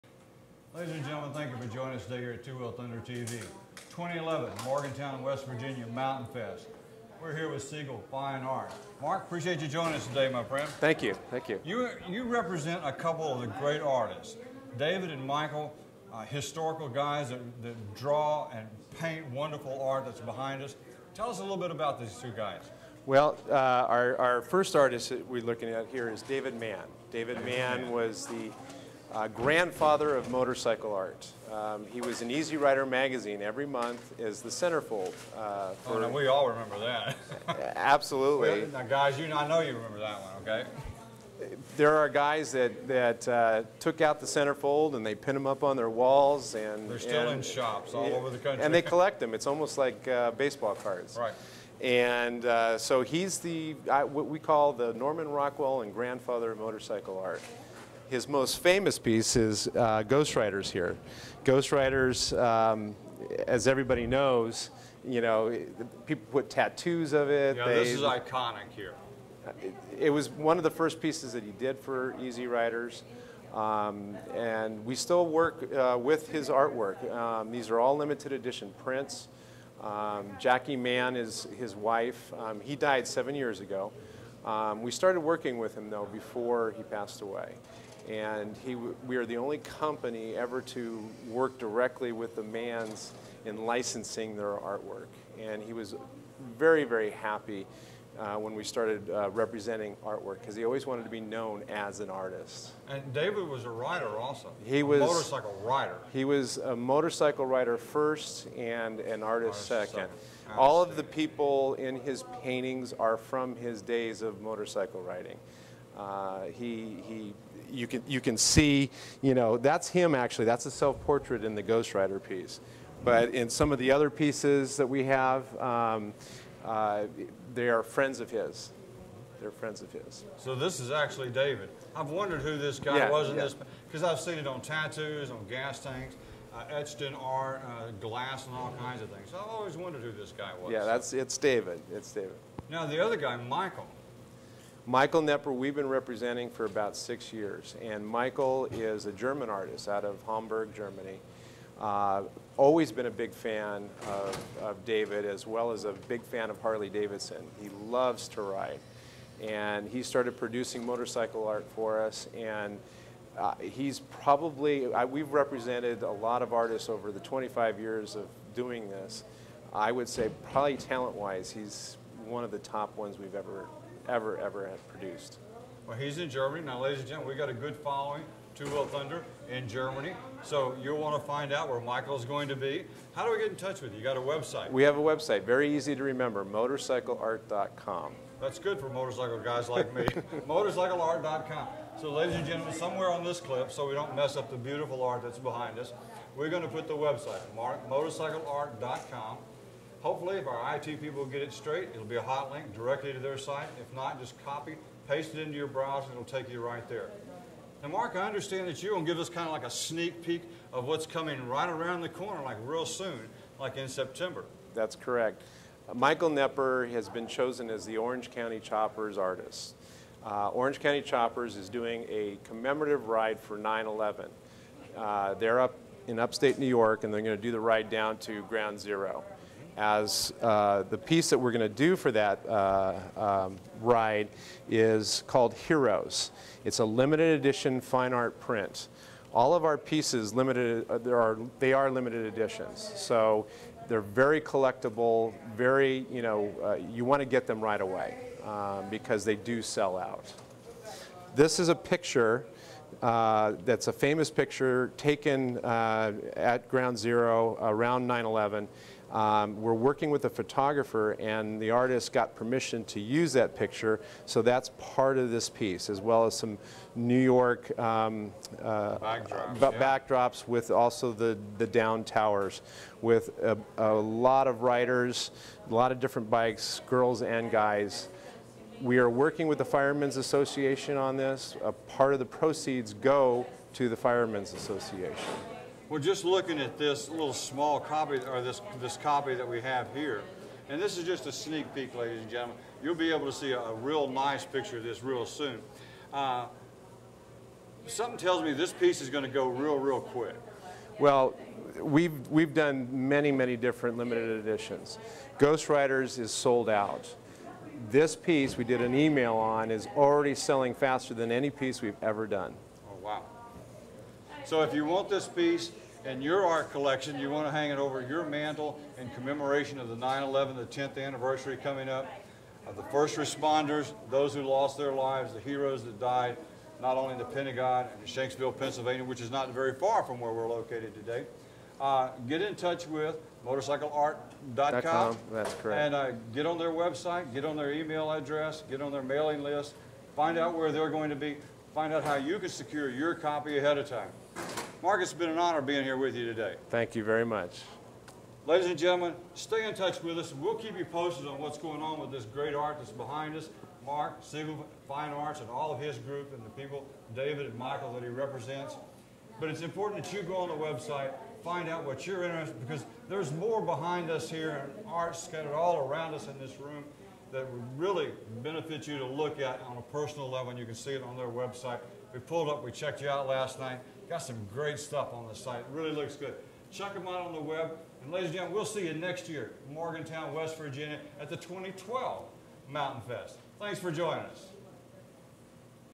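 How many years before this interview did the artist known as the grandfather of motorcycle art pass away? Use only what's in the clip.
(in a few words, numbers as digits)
7.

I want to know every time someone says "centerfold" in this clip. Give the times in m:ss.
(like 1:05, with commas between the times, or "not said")
0:34, 0:44.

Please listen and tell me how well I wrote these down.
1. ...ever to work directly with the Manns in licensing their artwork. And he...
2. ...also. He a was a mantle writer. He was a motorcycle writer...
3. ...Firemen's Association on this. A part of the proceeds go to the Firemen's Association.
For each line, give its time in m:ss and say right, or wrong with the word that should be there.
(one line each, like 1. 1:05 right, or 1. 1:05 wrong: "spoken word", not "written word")
1. 1:30 right
2. 1:44 wrong: "motorcycle", not "mantle"
3. 4:39 right.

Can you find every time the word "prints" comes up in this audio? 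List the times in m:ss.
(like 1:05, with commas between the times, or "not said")
1:18, 3:58.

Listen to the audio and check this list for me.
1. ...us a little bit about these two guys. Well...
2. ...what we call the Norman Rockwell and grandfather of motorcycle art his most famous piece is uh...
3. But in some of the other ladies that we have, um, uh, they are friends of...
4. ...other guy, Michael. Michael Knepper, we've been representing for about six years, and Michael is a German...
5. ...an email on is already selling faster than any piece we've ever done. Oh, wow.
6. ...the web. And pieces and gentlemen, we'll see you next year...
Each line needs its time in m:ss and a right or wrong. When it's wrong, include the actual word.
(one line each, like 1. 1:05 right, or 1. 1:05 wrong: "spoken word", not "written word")
1. 0:21 right
2. 0:53 right
3. 2:03 wrong: "pieces", not "ladies"
4. 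2:22 right
5. 5:08 right
6. 6:17 wrong: "ladies", not "pieces".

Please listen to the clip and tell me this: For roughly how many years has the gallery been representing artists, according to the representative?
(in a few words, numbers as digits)
25.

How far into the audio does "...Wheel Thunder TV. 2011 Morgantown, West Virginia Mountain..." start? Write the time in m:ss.
0:02.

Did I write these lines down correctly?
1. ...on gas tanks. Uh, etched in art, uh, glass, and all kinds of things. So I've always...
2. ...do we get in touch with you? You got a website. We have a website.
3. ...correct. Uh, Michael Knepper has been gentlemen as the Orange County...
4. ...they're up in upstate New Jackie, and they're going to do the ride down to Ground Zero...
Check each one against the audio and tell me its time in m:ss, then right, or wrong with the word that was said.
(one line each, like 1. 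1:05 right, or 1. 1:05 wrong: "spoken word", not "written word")
1. 2:15 right
2. 3:03 right
3. 3:34 wrong: "chosen", not "gentlemen"
4. 3:45 wrong: "York", not "Jackie".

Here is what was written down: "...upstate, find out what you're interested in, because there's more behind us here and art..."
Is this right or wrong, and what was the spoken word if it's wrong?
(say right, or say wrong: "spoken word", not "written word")
wrong: "website", not "upstate".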